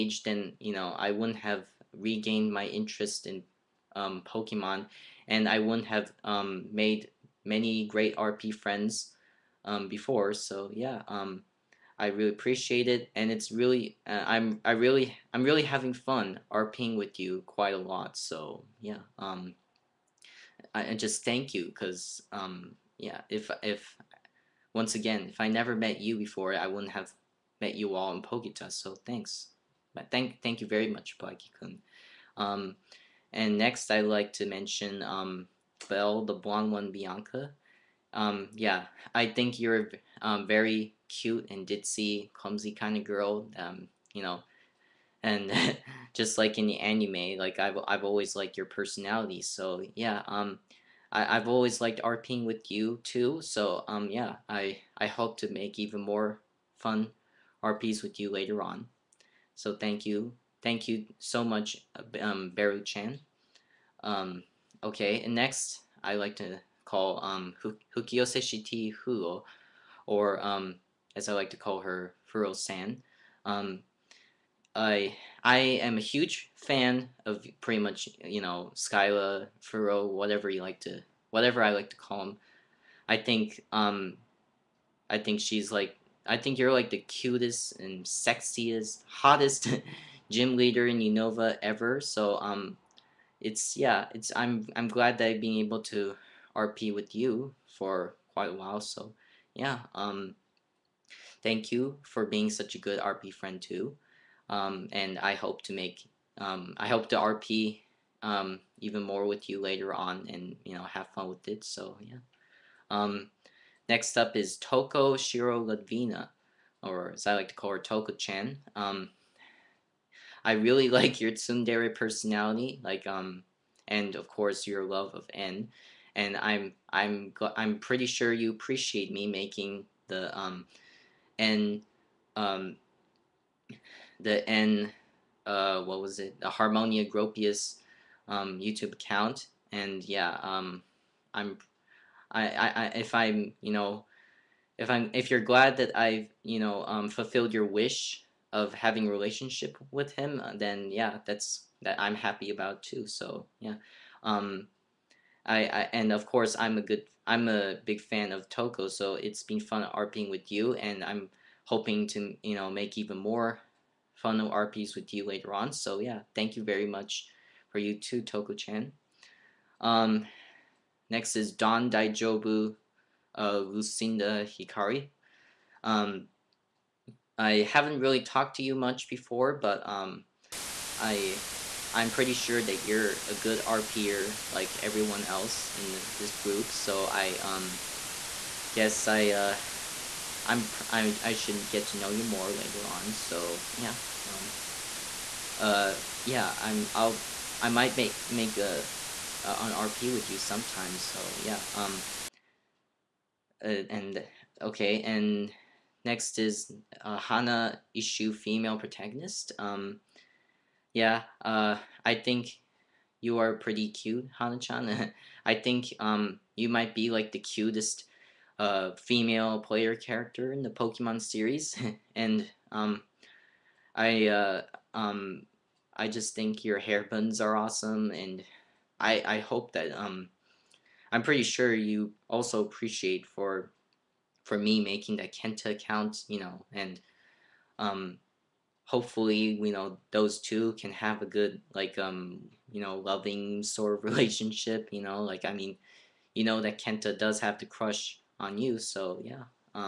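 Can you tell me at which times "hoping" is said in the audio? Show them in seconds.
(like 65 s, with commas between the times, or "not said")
161 s.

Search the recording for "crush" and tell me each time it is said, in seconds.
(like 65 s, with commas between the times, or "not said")
247 s.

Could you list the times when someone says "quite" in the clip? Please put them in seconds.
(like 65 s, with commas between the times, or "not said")
17 s, 98 s.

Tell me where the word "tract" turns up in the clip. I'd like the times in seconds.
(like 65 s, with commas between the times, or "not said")
not said.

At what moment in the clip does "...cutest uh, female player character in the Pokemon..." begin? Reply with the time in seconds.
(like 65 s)
217 s.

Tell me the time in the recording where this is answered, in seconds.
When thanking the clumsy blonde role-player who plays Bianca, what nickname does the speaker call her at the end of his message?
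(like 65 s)
62 s.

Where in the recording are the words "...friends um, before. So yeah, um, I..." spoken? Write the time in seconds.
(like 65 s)
8 s.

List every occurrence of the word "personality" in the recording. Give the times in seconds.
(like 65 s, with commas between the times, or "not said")
48 s, 121 s.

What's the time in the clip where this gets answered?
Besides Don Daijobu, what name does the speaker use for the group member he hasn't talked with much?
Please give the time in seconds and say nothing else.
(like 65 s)
173 s.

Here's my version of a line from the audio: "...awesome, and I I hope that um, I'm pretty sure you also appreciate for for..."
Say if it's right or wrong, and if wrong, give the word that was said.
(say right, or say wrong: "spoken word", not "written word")
right.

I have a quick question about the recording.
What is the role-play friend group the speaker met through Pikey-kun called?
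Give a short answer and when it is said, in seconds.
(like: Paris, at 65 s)
Poketa, at 28 s.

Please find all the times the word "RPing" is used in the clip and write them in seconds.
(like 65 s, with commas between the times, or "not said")
16 s, 52 s, 159 s.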